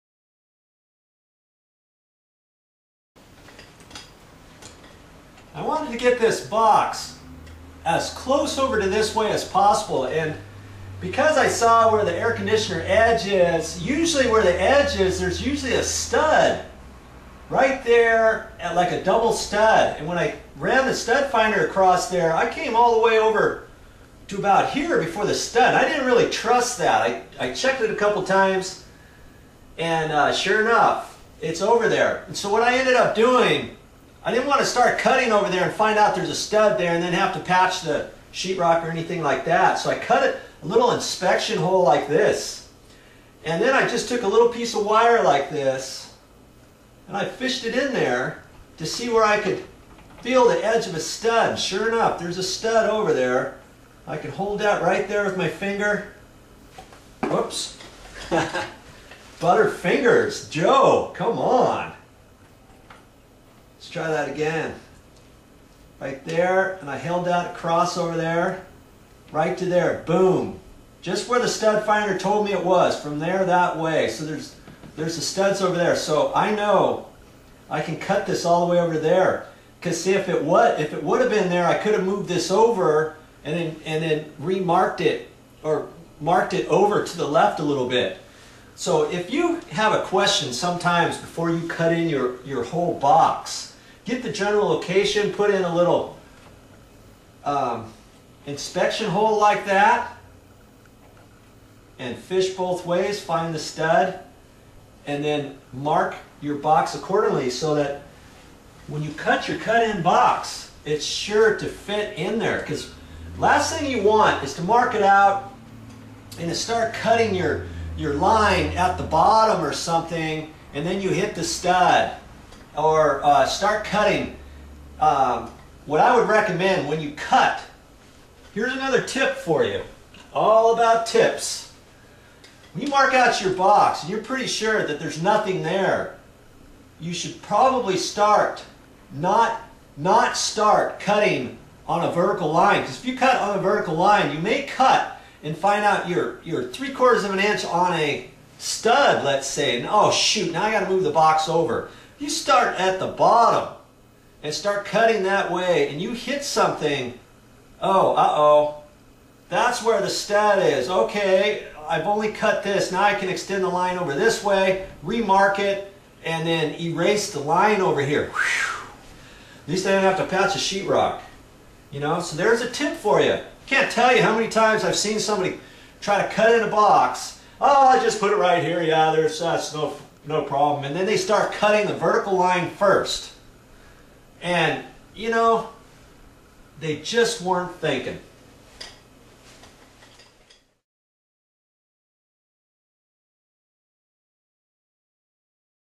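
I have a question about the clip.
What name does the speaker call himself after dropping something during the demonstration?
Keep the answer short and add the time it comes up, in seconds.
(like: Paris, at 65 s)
Joe, at 60 s.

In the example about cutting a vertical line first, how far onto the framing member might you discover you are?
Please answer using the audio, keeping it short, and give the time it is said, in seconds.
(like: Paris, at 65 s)
3/4 of an inch, at 146 s.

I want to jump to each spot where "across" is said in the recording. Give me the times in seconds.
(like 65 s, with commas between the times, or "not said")
21 s, 67 s.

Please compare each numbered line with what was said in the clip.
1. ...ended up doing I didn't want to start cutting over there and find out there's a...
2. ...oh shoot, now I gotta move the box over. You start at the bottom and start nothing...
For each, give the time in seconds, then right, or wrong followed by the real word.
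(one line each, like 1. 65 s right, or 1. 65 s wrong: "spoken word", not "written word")
1. 32 s right
2. 149 s wrong: "cutting", not "nothing".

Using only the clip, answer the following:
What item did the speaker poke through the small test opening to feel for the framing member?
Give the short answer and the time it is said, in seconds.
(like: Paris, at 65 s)
a little piece of wire, at 44 s.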